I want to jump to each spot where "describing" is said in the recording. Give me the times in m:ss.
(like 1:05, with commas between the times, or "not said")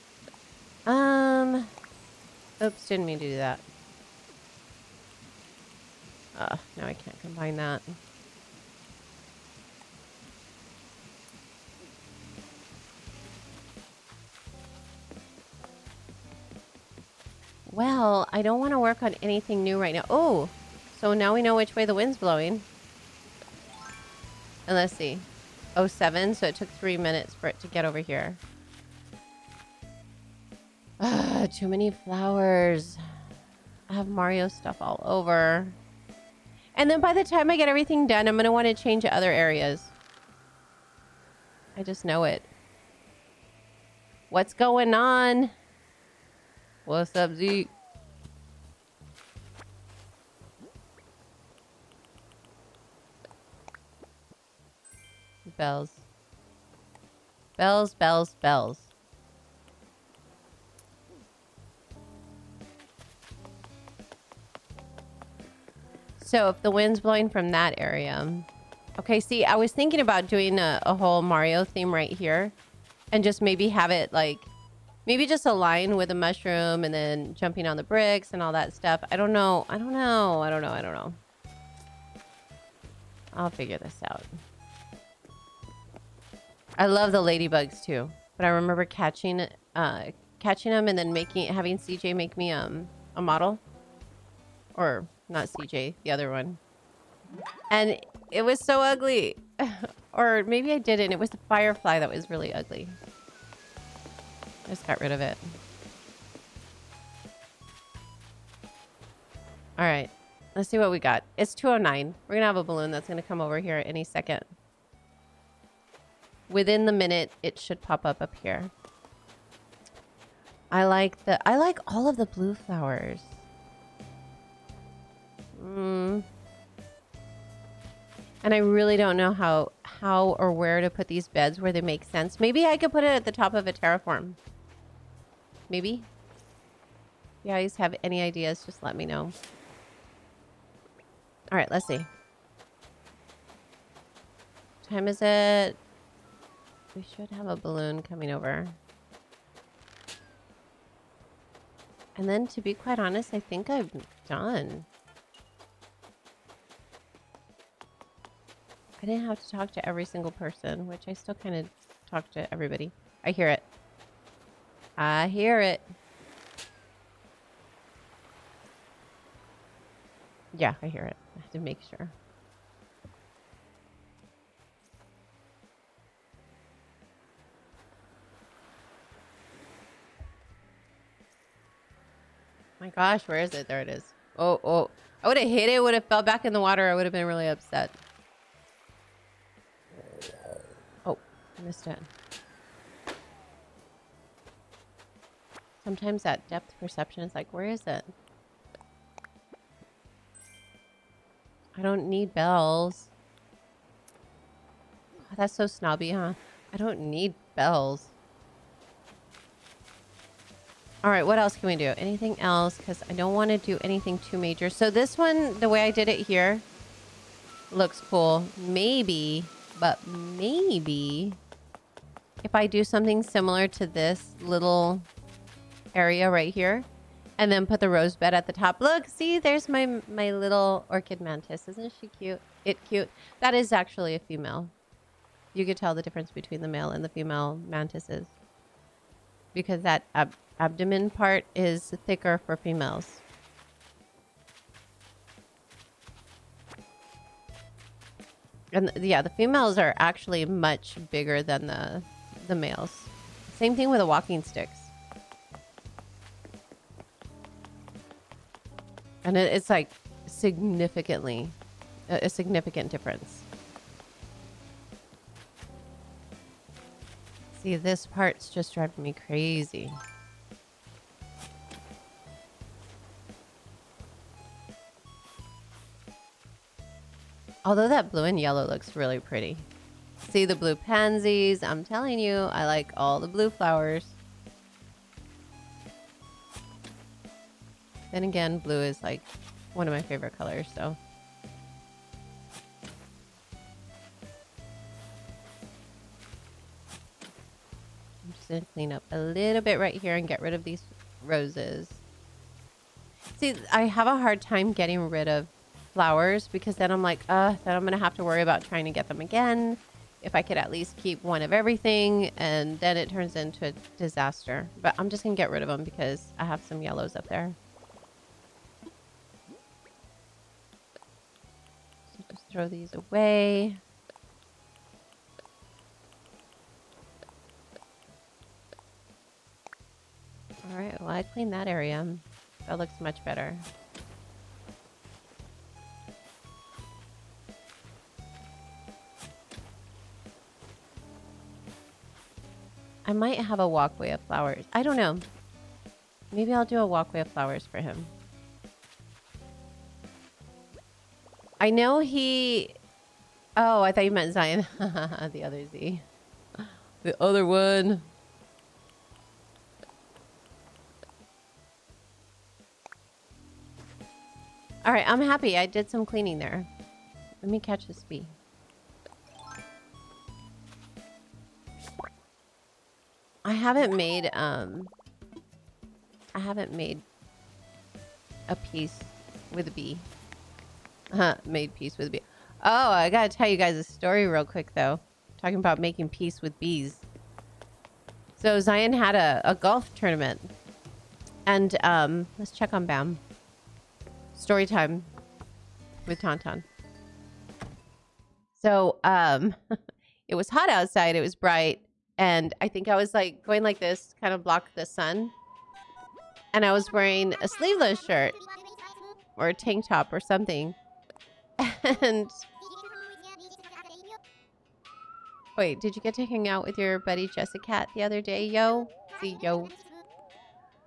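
not said.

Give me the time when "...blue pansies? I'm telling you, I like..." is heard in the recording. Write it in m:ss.
4:40.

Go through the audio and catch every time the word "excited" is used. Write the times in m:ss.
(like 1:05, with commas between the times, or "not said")
not said.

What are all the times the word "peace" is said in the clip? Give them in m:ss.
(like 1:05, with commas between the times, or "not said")
6:21, 6:26.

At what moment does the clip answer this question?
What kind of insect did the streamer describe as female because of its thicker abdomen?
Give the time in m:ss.
3:50.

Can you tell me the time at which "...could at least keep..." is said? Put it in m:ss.
5:10.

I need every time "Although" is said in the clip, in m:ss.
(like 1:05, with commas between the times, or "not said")
4:37.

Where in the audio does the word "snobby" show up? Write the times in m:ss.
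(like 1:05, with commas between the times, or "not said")
3:25.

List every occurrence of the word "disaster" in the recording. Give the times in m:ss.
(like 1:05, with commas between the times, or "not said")
5:13.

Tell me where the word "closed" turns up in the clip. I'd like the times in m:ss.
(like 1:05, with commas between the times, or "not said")
not said.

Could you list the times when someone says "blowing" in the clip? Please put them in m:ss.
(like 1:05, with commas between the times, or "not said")
0:22, 1:06.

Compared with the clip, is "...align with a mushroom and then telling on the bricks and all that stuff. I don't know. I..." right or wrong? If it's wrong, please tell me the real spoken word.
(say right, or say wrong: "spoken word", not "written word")
wrong: "jumping", not "telling".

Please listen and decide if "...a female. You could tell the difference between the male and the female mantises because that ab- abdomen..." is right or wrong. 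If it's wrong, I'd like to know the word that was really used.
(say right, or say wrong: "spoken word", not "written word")
right.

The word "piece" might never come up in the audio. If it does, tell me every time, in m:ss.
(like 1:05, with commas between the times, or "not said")
6:18.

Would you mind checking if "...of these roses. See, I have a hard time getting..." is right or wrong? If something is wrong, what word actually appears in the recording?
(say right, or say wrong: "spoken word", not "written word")
right.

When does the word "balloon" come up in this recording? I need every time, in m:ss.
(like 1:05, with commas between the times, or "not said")
1:52, 2:27.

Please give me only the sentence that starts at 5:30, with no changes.
Alright, well I cleaned that area.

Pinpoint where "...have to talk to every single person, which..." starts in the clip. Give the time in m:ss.
2:39.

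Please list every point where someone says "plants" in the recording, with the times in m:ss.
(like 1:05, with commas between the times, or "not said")
not said.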